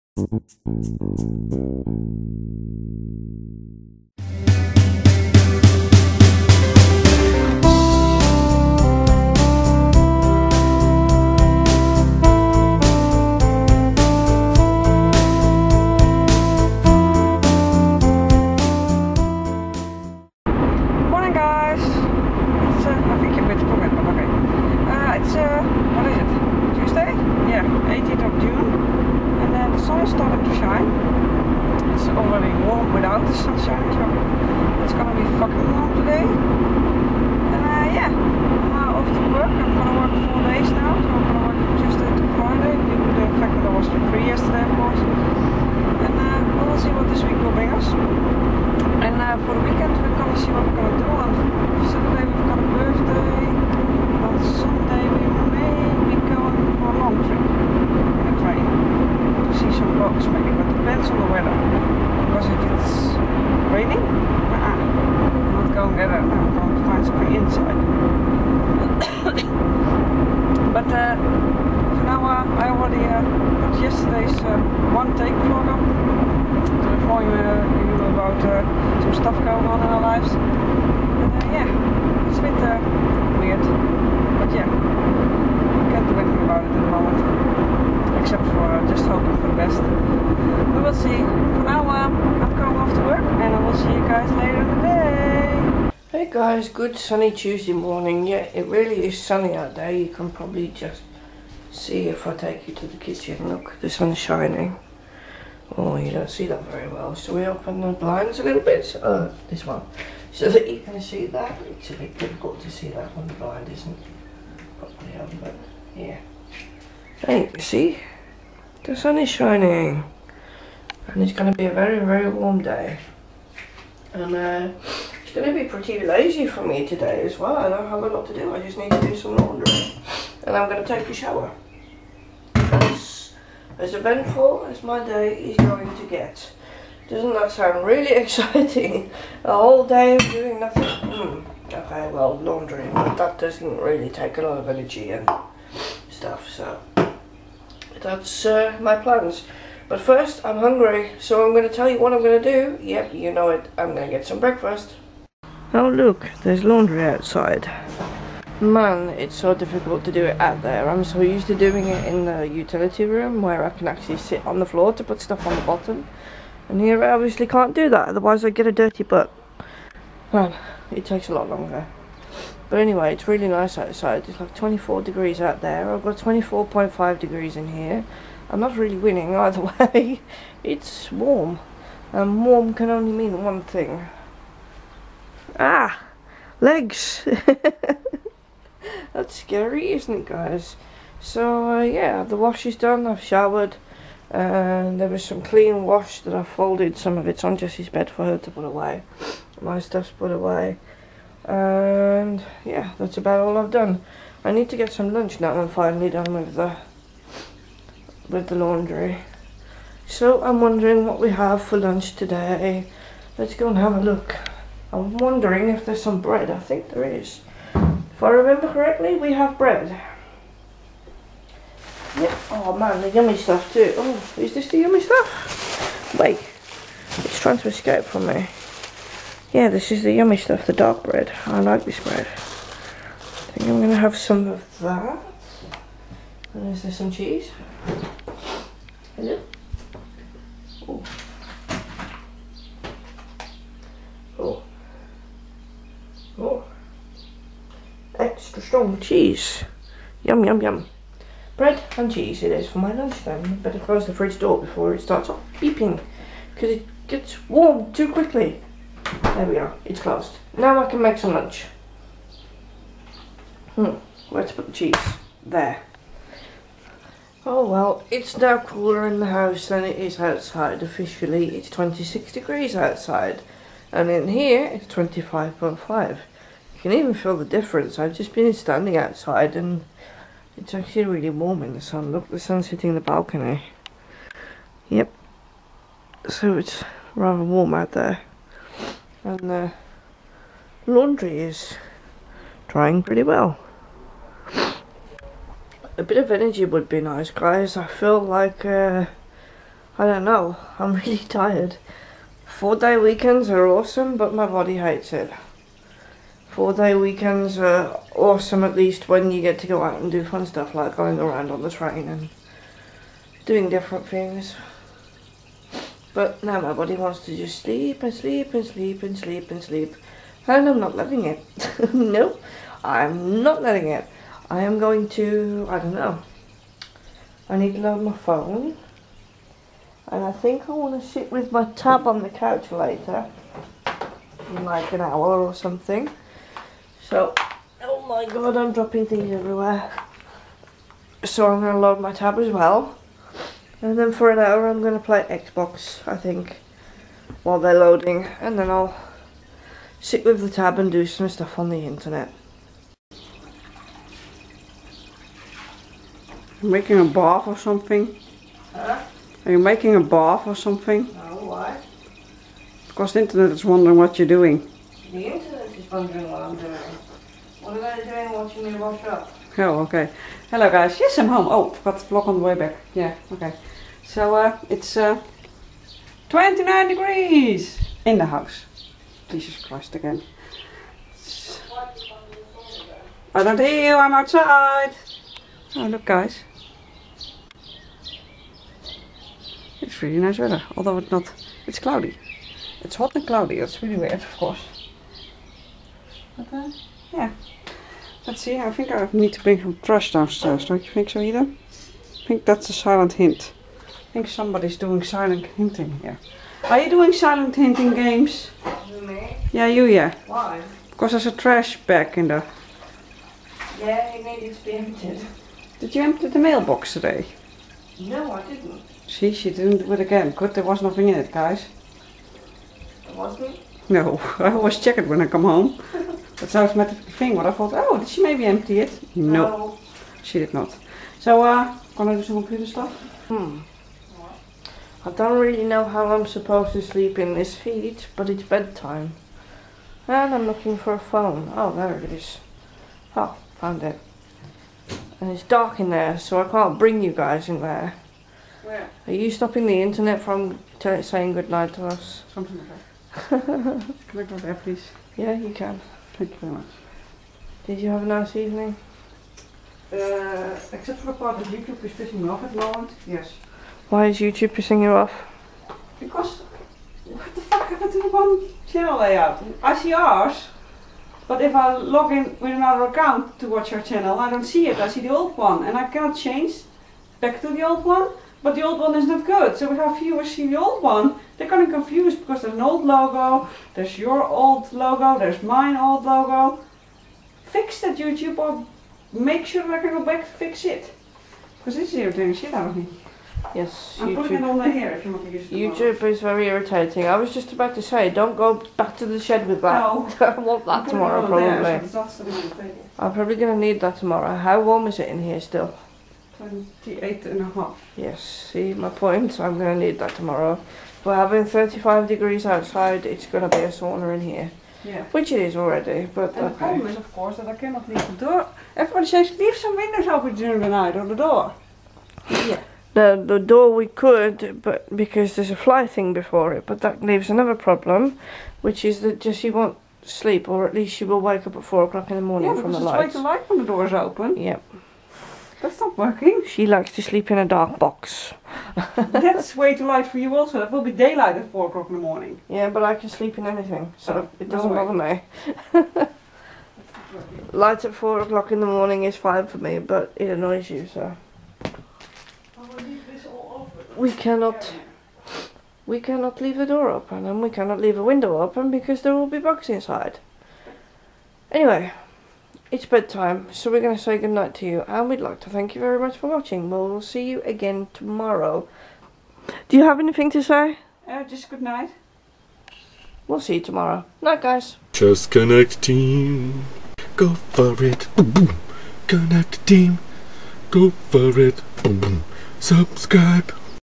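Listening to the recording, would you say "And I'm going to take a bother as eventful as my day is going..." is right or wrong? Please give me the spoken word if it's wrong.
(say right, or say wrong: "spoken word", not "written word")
wrong: "shower", not "bother".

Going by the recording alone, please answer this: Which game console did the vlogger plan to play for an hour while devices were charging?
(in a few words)
Xbox.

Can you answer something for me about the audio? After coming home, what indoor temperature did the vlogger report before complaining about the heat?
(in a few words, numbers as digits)
29 degrees.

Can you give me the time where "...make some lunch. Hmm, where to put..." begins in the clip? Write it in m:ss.
4:21.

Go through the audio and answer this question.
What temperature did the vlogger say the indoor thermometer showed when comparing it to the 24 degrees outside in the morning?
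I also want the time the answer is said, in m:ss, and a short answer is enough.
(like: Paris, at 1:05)
24.5 degrees, at 2:56.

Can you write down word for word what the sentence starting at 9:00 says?
That will be daylight at 4 o'clock in the morning.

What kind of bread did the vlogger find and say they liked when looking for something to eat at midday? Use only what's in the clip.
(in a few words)
dark bread.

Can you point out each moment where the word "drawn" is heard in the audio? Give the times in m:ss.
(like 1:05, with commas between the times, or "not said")
not said.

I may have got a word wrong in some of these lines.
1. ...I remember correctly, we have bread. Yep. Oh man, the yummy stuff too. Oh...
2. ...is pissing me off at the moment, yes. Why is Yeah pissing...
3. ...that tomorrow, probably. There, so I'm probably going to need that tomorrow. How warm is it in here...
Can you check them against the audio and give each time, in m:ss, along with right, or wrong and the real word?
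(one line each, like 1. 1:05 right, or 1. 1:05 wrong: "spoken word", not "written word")
1. 3:38 right
2. 7:41 wrong: "YouTube", not "Yeah"
3. 8:20 right.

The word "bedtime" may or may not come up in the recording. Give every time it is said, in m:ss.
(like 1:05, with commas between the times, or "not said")
7:18, 9:22.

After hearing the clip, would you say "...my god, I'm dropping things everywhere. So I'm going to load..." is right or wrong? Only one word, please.
right.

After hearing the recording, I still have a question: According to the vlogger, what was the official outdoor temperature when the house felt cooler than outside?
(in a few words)
26 degrees.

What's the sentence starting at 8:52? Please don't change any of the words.
Yeah, because the light when the door is open.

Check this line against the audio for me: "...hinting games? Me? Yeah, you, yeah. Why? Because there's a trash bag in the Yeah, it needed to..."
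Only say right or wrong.
right.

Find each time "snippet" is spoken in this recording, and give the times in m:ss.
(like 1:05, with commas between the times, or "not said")
not said.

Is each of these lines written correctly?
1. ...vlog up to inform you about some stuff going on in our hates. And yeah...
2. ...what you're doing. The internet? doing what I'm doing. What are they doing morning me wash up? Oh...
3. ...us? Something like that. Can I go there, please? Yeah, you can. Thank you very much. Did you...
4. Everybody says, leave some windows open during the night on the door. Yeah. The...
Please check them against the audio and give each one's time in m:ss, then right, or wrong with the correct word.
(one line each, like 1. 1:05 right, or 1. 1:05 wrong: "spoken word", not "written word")
1. 1:15 wrong: "lives", not "hates"
2. 6:03 wrong: "watching", not "morning"
3. 7:31 right
4. 8:38 right.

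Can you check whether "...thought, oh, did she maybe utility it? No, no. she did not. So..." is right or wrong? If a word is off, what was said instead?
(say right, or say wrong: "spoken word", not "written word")
wrong: "empty", not "utility".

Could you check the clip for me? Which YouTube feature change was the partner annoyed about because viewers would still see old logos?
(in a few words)
one channel layout.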